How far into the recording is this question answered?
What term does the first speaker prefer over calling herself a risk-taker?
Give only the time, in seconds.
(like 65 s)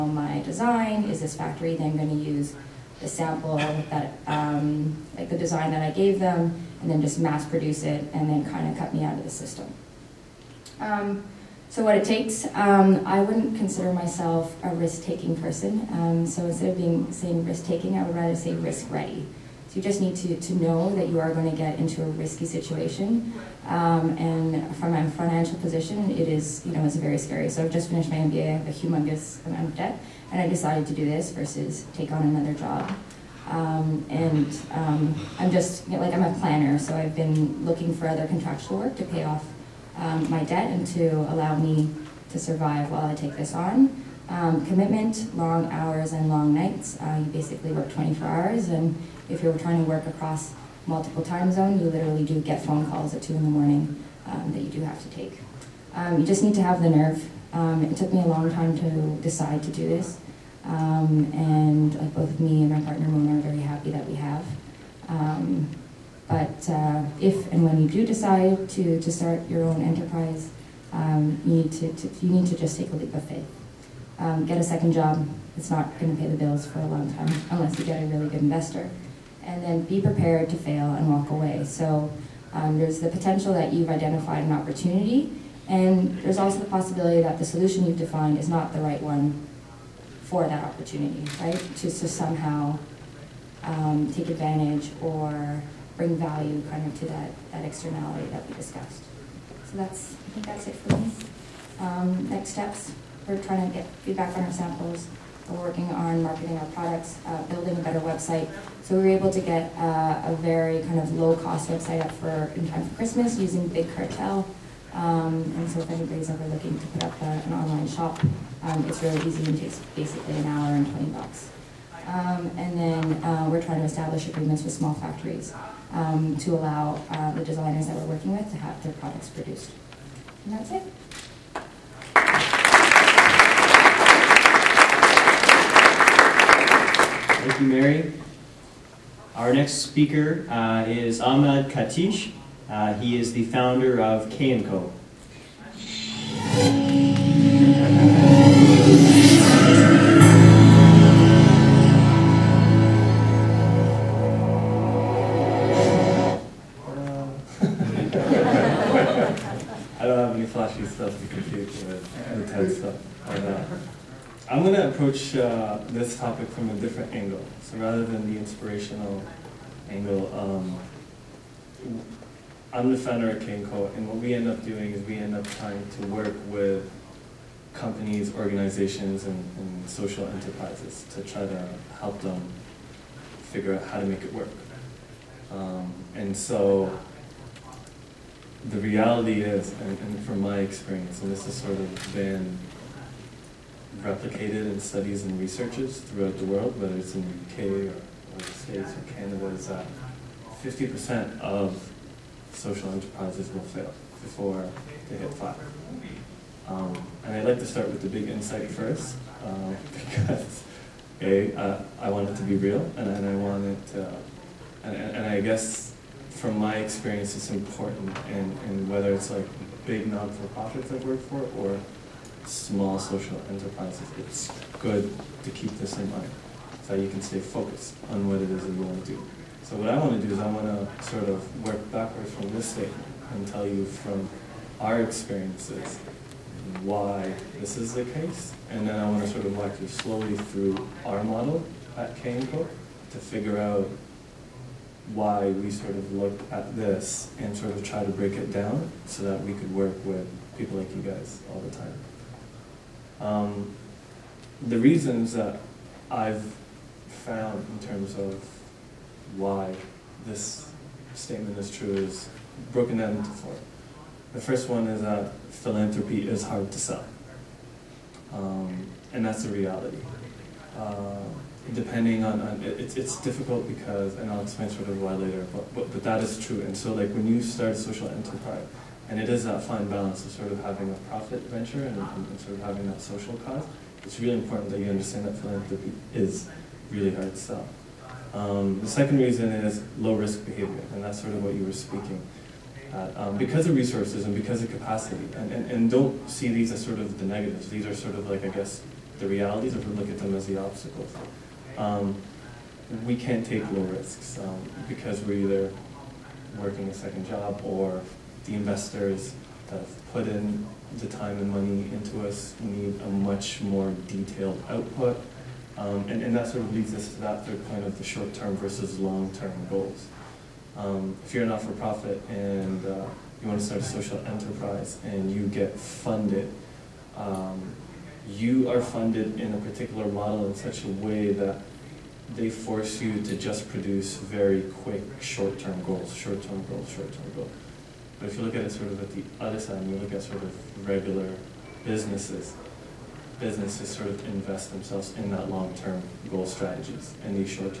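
18 s.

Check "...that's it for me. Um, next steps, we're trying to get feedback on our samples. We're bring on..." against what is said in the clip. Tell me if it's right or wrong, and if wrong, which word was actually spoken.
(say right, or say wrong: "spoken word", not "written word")
wrong: "working", not "bring".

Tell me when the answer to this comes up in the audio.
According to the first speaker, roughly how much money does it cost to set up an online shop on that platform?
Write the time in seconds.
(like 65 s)
120 s.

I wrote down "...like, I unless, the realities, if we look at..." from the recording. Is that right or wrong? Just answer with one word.
wrong.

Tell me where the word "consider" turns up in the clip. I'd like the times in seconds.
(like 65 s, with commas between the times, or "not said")
13 s.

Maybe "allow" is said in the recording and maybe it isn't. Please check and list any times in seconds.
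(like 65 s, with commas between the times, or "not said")
41 s, 126 s.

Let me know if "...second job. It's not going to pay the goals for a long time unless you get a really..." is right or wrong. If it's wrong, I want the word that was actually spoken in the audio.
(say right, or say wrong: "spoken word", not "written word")
wrong: "bills", not "goals".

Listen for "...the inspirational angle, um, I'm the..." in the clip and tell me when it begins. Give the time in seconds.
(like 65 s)
168 s.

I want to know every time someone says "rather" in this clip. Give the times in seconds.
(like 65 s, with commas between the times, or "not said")
18 s, 167 s.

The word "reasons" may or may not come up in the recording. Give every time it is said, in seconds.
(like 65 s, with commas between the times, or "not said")
254 s, 289 s.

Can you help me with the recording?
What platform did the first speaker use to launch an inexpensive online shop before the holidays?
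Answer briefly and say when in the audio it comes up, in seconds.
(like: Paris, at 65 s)
Big Cartel, at 113 s.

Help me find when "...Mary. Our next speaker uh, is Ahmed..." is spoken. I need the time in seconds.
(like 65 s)
137 s.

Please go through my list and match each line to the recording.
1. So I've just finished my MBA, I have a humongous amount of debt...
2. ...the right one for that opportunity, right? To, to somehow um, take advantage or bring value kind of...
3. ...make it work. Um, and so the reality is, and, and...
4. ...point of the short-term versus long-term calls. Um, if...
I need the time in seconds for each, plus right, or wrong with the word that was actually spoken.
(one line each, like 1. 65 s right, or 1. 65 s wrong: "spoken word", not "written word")
1. 27 s right
2. 88 s right
3. 184 s right
4. 317 s wrong: "goals", not "calls".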